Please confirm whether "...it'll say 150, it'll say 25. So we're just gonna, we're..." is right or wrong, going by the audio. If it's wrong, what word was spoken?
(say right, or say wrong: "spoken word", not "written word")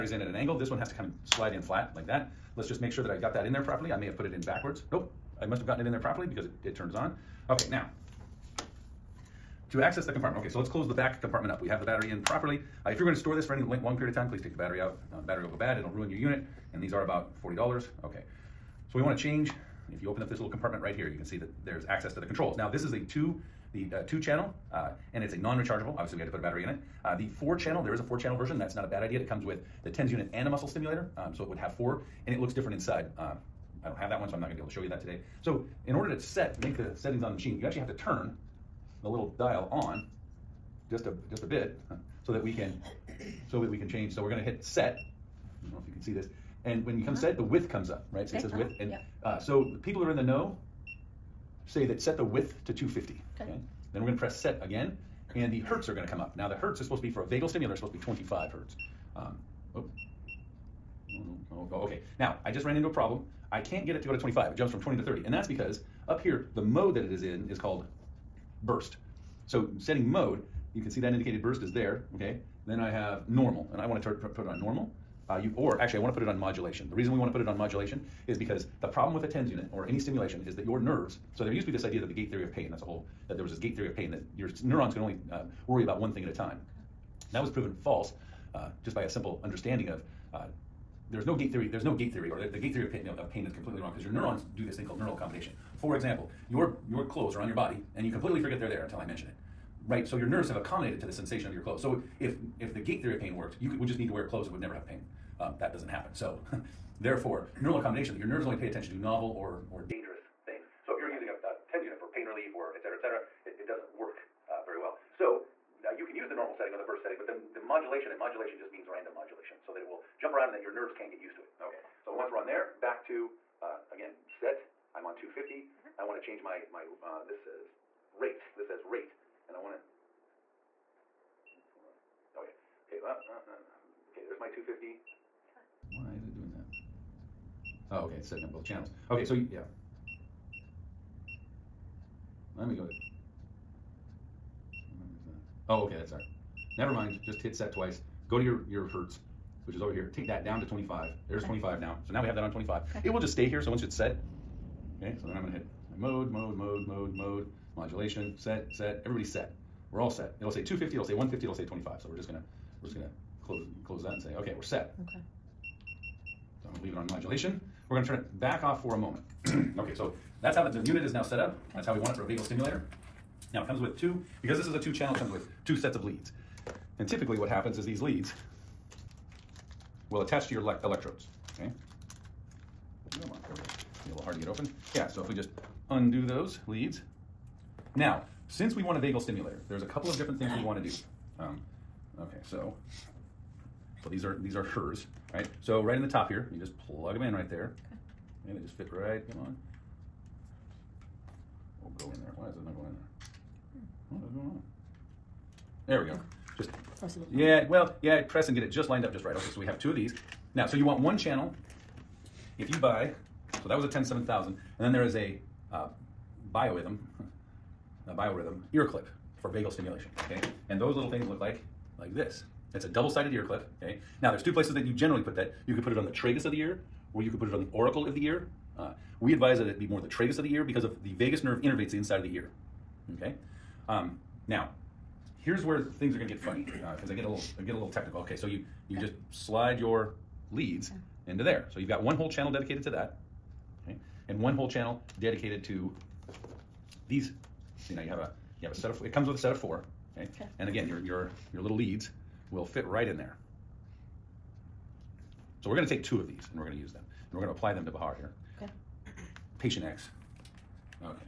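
right.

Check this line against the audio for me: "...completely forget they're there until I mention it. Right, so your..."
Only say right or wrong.
right.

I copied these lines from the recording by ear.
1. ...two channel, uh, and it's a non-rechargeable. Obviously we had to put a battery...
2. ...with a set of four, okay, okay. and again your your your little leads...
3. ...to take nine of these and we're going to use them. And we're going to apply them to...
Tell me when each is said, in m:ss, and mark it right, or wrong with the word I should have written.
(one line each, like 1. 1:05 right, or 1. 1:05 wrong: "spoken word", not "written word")
1. 0:24 right
2. 4:09 right
3. 4:15 wrong: "two", not "nine".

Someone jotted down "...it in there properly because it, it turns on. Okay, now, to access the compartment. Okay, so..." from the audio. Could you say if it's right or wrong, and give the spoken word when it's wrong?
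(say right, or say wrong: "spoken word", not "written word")
right.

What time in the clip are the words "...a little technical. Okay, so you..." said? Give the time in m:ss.
3:57.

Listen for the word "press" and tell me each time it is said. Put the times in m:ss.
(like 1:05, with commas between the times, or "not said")
0:54, 3:28.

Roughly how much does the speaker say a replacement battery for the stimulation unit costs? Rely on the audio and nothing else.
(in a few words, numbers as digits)
$40.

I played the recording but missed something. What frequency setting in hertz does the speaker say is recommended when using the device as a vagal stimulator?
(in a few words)
25 hertz.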